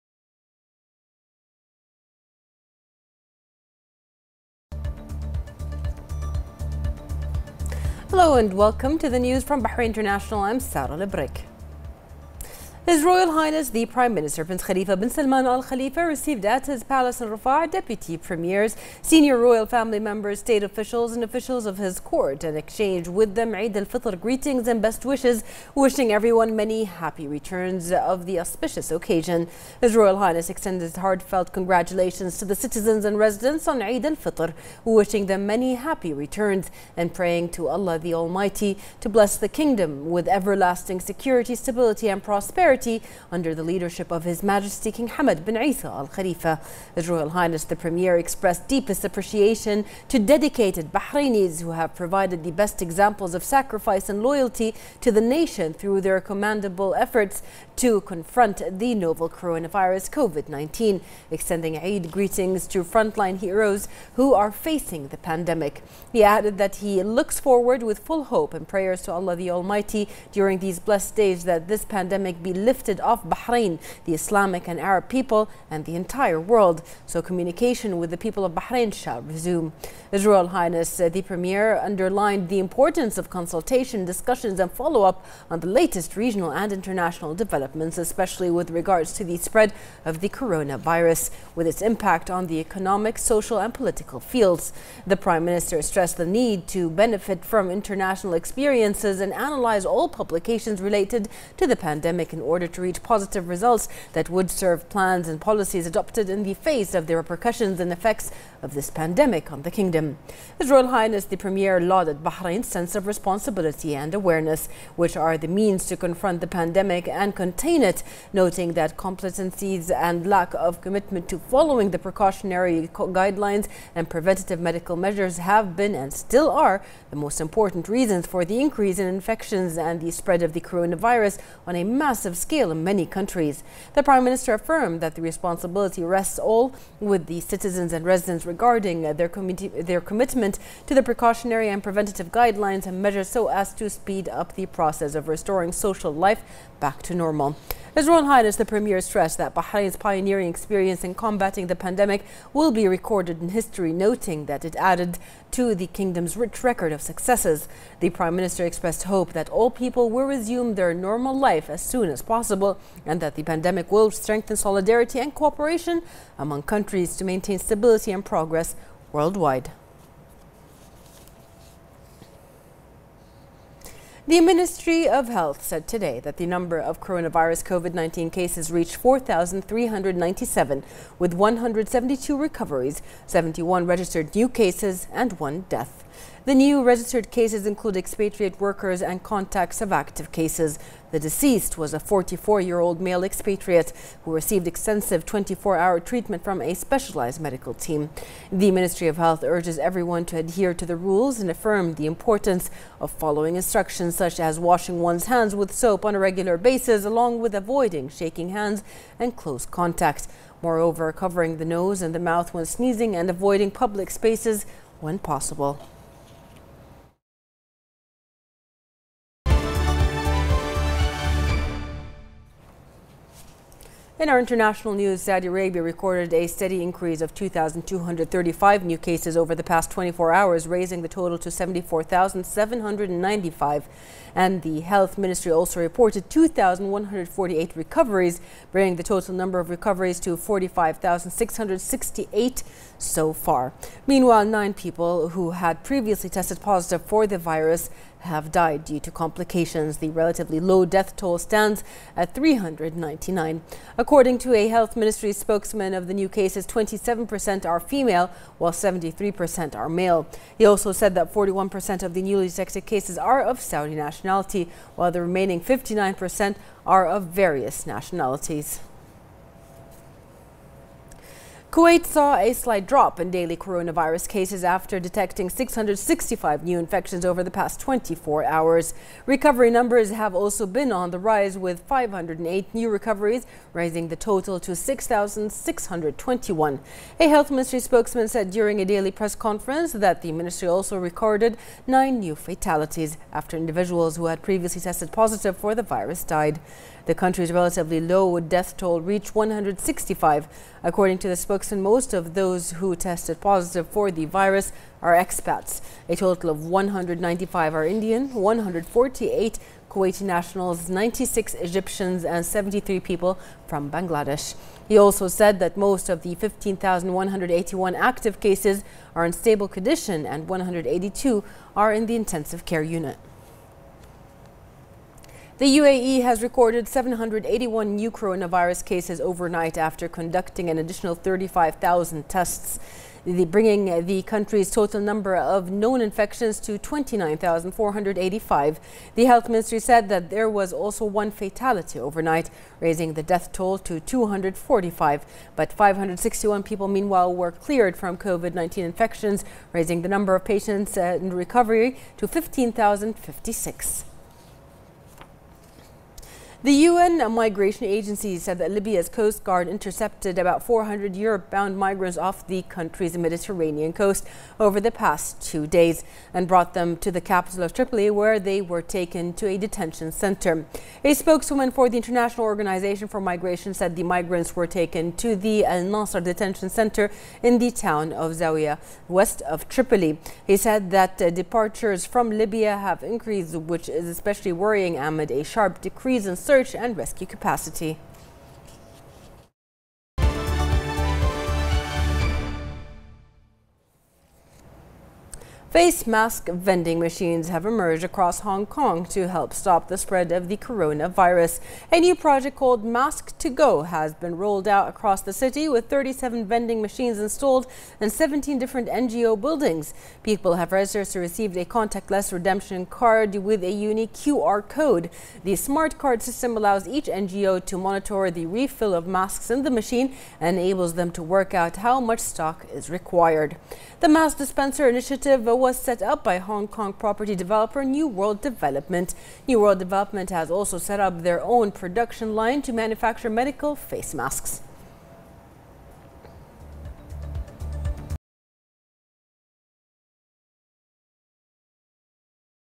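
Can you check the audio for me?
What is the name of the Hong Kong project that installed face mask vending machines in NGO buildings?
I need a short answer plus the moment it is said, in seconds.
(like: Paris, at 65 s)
Mask to Go, at 402 s.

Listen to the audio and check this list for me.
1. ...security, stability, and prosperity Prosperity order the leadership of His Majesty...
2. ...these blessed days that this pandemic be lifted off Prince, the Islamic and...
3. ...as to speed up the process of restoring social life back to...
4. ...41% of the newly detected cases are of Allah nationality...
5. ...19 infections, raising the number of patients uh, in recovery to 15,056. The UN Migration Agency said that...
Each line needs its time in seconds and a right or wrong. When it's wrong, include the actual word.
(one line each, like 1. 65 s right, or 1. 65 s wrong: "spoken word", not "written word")
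1. 40 s wrong: "under", not "order"
2. 70 s wrong: "Bahrain", not "Prince"
3. 143 s right
4. 261 s wrong: "Saudi", not "Allah"
5. 348 s right.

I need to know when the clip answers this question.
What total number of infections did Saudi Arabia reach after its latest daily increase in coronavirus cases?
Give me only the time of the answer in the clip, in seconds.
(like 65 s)
231 s.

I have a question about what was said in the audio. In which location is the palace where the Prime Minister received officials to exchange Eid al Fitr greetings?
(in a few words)
Riffa.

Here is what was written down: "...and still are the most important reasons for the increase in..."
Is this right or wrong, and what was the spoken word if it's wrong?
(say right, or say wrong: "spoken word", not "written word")
right.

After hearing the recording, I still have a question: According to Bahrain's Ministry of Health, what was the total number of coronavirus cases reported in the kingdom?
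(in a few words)
4,397.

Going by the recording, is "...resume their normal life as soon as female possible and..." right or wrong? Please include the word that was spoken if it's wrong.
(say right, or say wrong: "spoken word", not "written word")
wrong: "possible", not "female".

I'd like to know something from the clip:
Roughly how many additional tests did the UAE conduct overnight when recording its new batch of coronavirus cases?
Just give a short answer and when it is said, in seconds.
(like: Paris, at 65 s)
35,000, at 331 s.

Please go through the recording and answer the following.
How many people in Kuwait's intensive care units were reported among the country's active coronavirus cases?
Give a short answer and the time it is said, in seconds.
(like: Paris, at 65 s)
182, at 320 s.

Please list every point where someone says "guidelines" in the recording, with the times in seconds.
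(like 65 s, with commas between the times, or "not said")
122 s, 142 s.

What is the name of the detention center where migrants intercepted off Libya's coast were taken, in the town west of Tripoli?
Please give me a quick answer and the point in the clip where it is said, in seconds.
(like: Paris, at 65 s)
Al Nasser, at 375 s.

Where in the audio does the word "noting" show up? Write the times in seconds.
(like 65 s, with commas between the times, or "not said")
118 s, 153 s.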